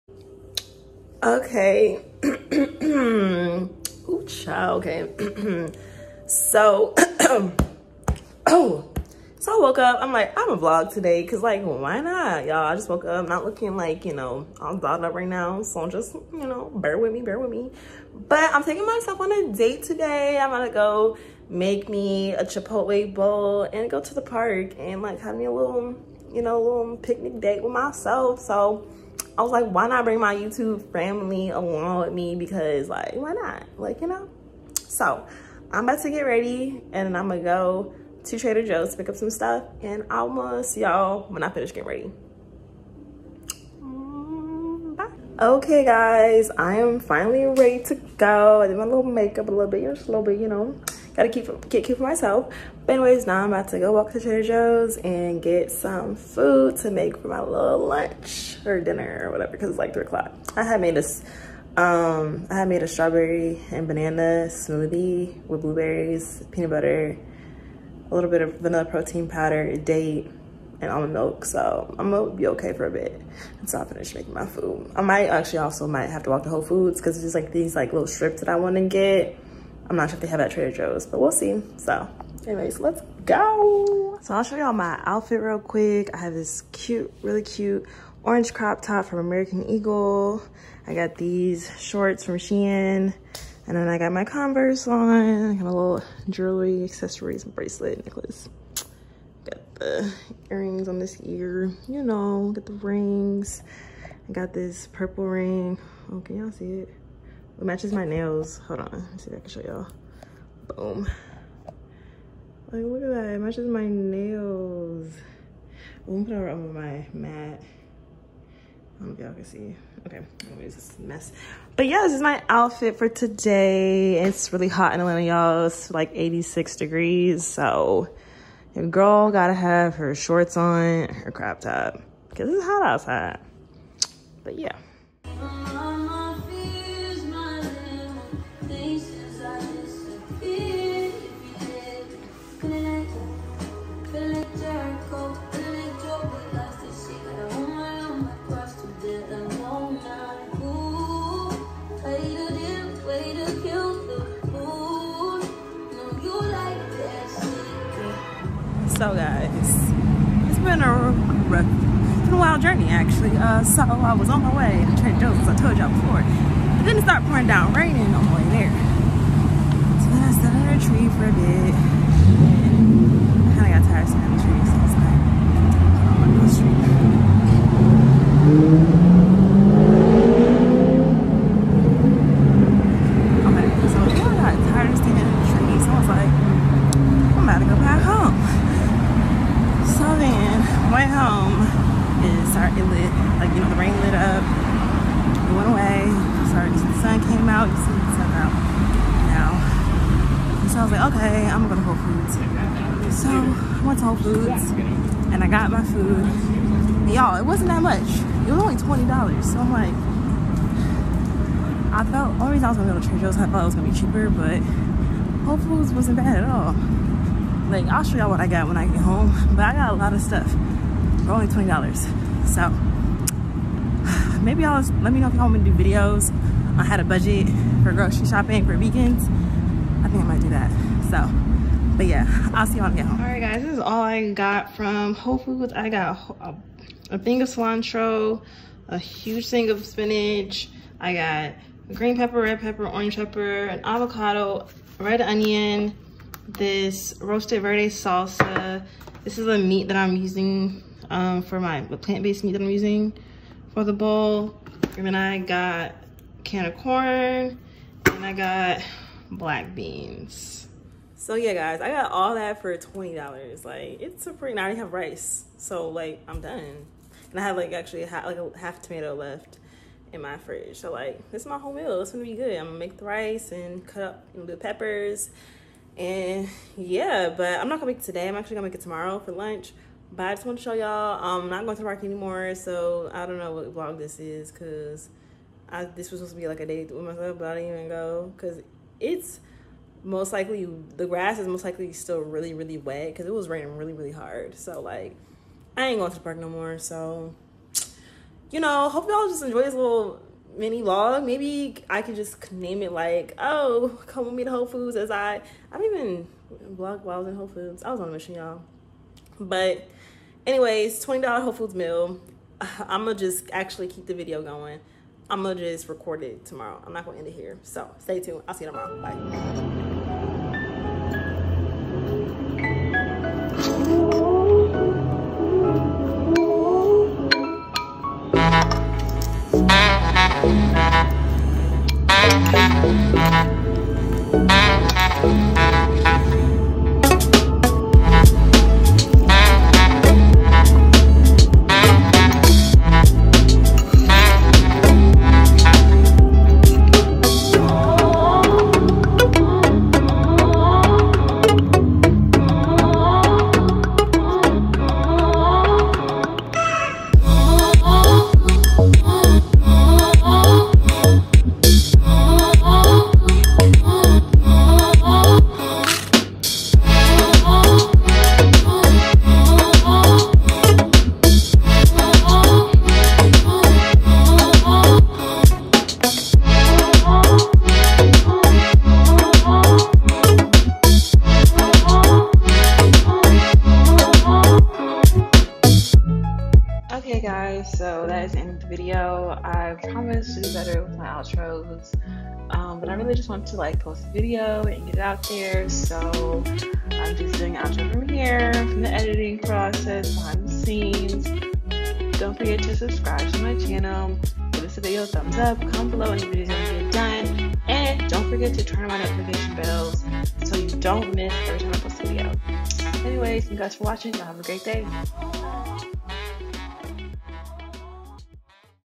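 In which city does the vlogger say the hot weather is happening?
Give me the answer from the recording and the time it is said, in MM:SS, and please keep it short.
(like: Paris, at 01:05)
Atlanta, at 02:04.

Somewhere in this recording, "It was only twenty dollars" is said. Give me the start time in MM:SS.
03:28.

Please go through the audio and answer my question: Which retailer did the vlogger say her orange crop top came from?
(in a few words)
American Eagle.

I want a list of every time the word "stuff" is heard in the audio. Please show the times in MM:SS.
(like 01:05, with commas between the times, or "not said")
00:39, 03:40.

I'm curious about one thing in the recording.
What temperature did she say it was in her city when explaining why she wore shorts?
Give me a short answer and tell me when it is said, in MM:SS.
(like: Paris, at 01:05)
86 degrees, at 02:06.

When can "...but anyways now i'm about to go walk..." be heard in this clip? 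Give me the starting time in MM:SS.
00:52.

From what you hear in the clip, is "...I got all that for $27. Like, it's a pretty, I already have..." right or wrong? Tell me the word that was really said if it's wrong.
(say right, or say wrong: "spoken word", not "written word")
wrong: "20", not "27".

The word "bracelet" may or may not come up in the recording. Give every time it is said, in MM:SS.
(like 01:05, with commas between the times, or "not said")
01:37.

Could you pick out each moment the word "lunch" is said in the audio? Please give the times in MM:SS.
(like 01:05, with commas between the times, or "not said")
00:57, 04:39.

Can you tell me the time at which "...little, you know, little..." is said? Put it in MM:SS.
00:25.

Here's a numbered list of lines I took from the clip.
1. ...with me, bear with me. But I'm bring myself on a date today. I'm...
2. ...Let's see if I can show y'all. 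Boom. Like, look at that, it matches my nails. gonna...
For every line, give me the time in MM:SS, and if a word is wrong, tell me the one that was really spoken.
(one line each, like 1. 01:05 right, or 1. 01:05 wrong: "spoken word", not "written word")
1. 00:16 wrong: "taking", not "bring"
2. 01:49 right.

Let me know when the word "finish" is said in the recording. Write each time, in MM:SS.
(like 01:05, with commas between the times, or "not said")
00:41, 01:13.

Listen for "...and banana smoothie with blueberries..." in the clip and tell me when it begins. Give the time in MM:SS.
01:03.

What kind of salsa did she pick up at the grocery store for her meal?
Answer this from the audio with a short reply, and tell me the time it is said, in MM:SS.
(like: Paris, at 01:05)
roasted verde salsa, at 04:07.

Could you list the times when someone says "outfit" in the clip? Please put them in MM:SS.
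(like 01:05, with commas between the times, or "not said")
01:25, 02:02.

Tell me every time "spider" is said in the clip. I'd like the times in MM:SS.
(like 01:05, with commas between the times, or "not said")
not said.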